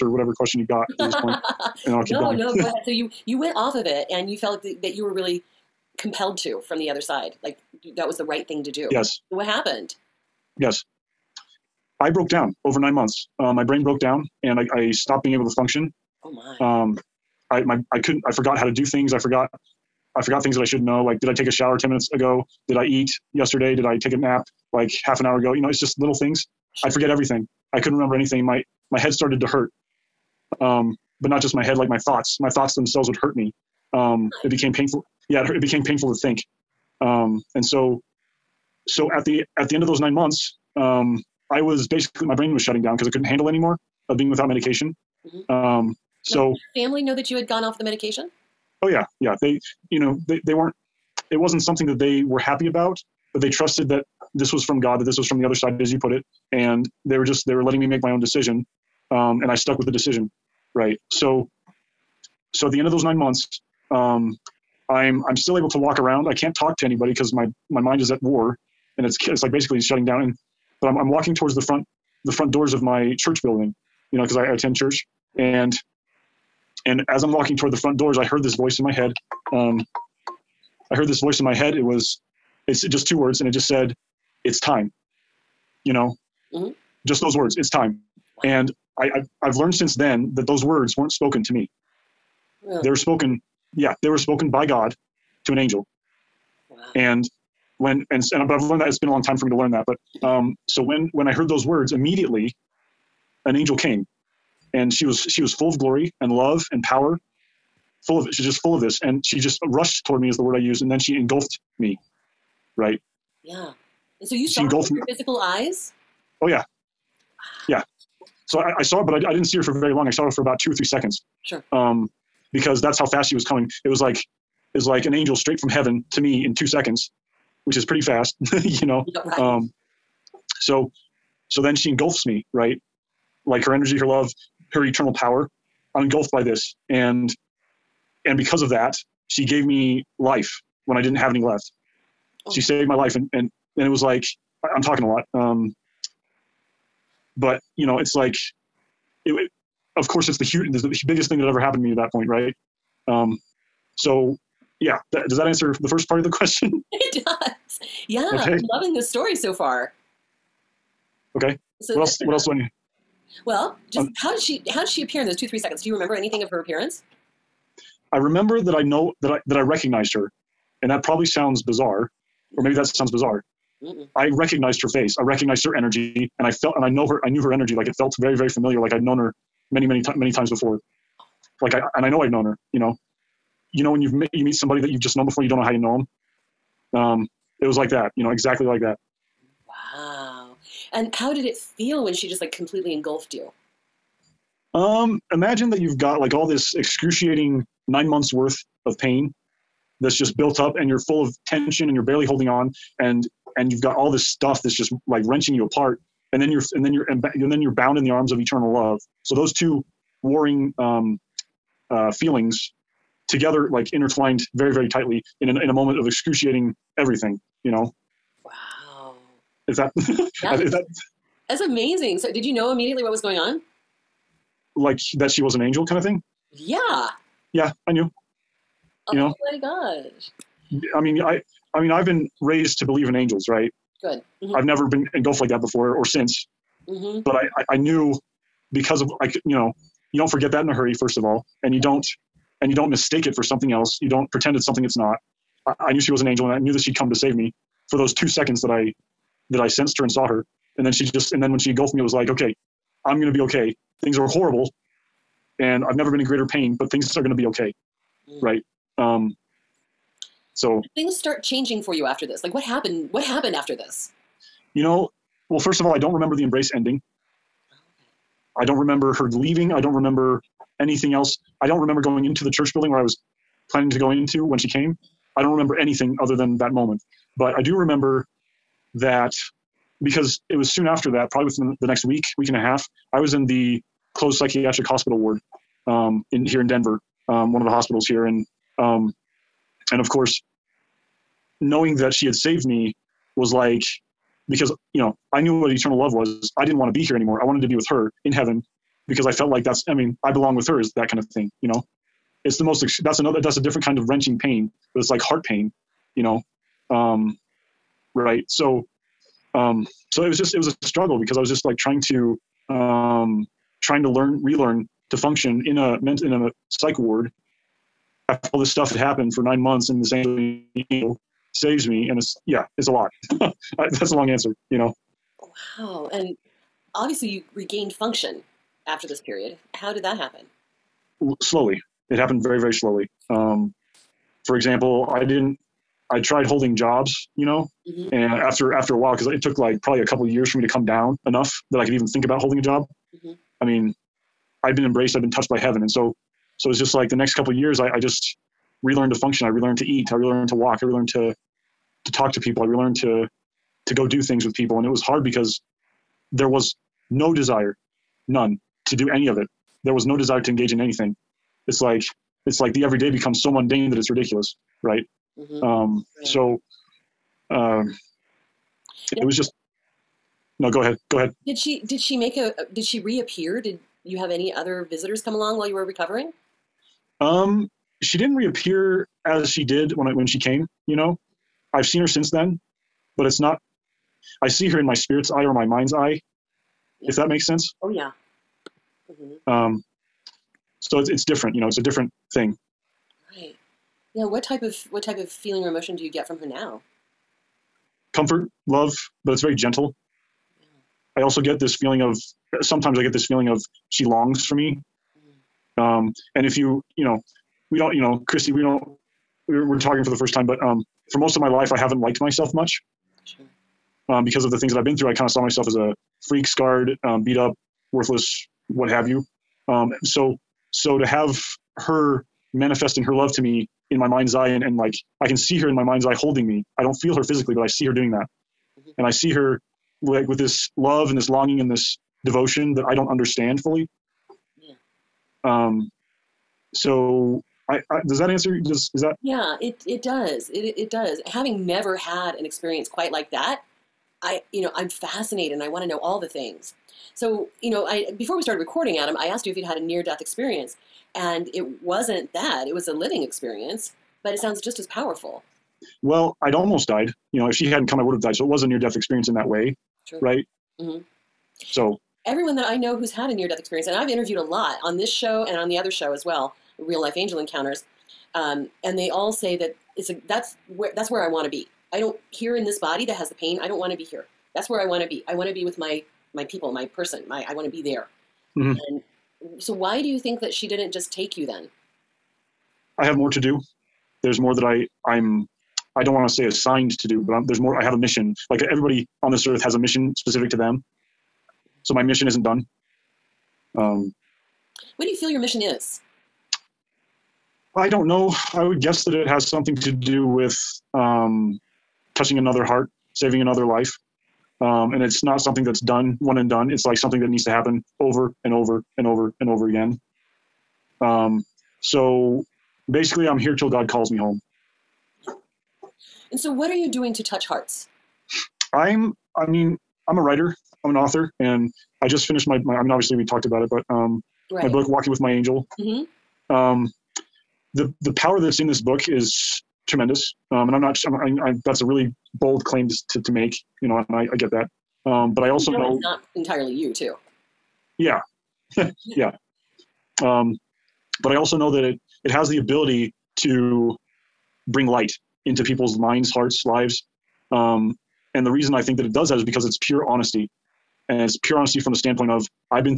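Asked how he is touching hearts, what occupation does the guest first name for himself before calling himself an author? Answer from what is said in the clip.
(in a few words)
Writer.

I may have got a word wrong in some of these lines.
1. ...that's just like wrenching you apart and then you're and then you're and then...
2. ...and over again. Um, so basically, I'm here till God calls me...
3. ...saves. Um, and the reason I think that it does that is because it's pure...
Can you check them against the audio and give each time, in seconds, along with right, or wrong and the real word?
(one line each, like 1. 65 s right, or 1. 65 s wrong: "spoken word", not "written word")
1. 204 s right
2. 509 s right
3. 546 s wrong: "lives", not "saves".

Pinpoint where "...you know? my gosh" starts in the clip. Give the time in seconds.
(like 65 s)
229 s.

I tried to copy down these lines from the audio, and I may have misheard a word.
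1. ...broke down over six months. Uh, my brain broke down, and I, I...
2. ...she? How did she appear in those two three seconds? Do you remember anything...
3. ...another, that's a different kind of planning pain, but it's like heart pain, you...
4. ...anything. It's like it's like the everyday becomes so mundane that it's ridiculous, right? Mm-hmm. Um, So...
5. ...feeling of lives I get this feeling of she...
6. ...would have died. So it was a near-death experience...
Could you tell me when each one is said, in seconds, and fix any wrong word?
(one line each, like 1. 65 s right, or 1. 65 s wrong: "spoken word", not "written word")
1. 12 s wrong: "nine", not "six"
2. 164 s right
3. 303 s wrong: "wrenching", not "planning"
4. 360 s right
5. 401 s wrong: "sometimes", not "lives"
6. 458 s right.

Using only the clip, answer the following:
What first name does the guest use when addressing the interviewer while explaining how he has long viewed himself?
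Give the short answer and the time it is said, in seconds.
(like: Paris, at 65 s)
Christi, at 408 s.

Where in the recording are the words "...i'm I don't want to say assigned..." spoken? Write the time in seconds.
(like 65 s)
485 s.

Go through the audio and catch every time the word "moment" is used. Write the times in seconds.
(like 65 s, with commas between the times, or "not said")
215 s, 276 s.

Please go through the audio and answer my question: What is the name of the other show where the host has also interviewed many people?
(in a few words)
Real Life Angel Encounters.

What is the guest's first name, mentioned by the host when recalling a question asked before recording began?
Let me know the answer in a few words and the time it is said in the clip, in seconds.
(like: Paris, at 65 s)
Adam, at 448 s.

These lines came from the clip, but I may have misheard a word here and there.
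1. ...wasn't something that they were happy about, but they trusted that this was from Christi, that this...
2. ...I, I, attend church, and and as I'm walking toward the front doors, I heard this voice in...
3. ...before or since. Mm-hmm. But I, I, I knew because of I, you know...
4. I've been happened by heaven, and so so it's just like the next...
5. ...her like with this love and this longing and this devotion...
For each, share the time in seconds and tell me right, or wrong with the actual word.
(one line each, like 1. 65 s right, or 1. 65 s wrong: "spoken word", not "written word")
1. 51 s wrong: "God", not "Christi"
2. 74 s right
3. 235 s right
4. 345 s wrong: "touched", not "happened"
5. 429 s right.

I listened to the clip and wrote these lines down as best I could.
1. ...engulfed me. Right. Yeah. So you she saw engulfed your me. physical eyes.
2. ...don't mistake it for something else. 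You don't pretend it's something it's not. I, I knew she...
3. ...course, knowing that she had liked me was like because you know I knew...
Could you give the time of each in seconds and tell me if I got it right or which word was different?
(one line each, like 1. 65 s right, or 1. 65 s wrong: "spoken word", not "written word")
1. 111 s right
2. 242 s right
3. 290 s wrong: "saved", not "liked".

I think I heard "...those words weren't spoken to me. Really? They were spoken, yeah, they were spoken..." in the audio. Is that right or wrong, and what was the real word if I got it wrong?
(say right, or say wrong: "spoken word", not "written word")
right.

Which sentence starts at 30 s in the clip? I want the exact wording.
Um, but not just my head, like my thoughts.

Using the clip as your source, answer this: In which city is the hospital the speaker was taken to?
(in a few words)
Denver.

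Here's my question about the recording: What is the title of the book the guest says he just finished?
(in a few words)
Walking with My Angel.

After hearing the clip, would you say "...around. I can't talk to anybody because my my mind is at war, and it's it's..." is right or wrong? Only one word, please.
right.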